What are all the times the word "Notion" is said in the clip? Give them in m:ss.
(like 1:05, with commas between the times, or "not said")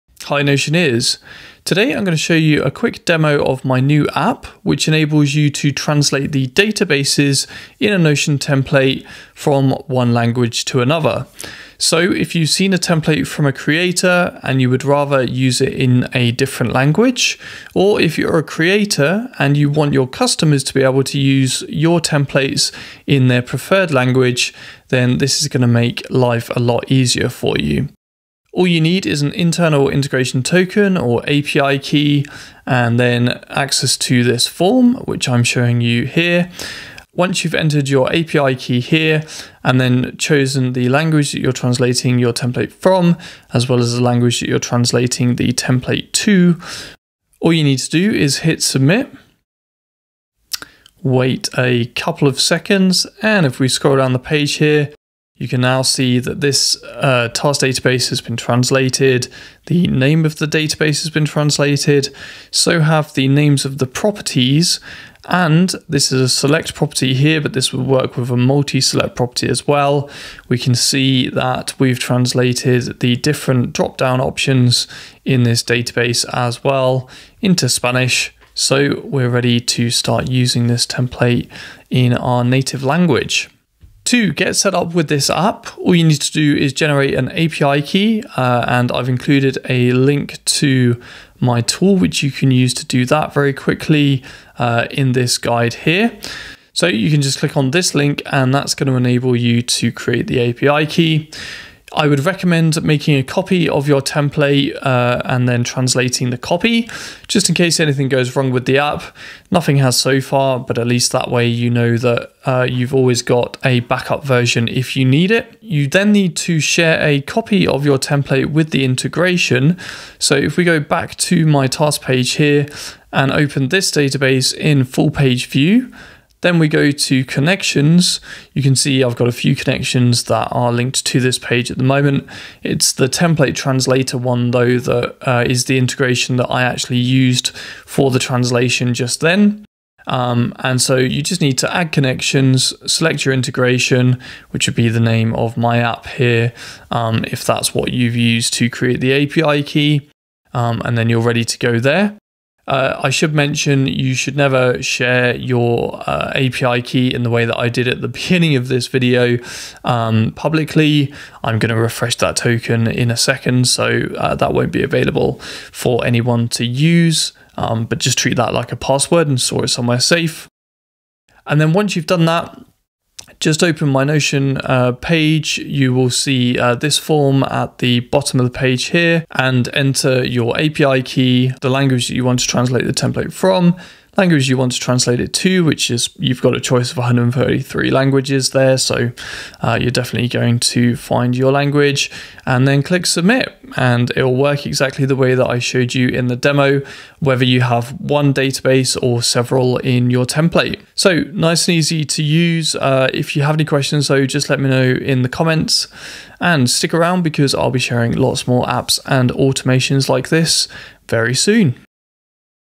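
0:07, 2:54.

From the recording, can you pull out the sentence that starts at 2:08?
You can see I've got a few connections that are linked to this page at the moment.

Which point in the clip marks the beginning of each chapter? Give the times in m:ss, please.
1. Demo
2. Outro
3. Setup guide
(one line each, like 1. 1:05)
1. 0:28
2. 3:20
3. 1:23.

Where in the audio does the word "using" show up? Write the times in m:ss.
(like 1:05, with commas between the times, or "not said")
1:20.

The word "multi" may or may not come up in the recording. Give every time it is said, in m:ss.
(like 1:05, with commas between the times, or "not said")
1:08.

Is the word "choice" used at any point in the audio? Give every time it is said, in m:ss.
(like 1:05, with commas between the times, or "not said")
3:06.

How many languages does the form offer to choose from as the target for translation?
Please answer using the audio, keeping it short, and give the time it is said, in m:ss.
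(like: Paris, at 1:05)
133, at 3:06.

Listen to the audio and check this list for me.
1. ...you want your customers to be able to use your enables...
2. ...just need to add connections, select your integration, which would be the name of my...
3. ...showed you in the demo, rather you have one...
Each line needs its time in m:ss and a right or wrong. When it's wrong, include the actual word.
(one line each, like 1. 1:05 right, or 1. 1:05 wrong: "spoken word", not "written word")
1. 0:19 wrong: "templates", not "enables"
2. 2:21 right
3. 3:15 wrong: "whether", not "rather".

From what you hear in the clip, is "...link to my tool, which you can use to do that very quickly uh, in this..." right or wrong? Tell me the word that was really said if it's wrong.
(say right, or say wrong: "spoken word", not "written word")
right.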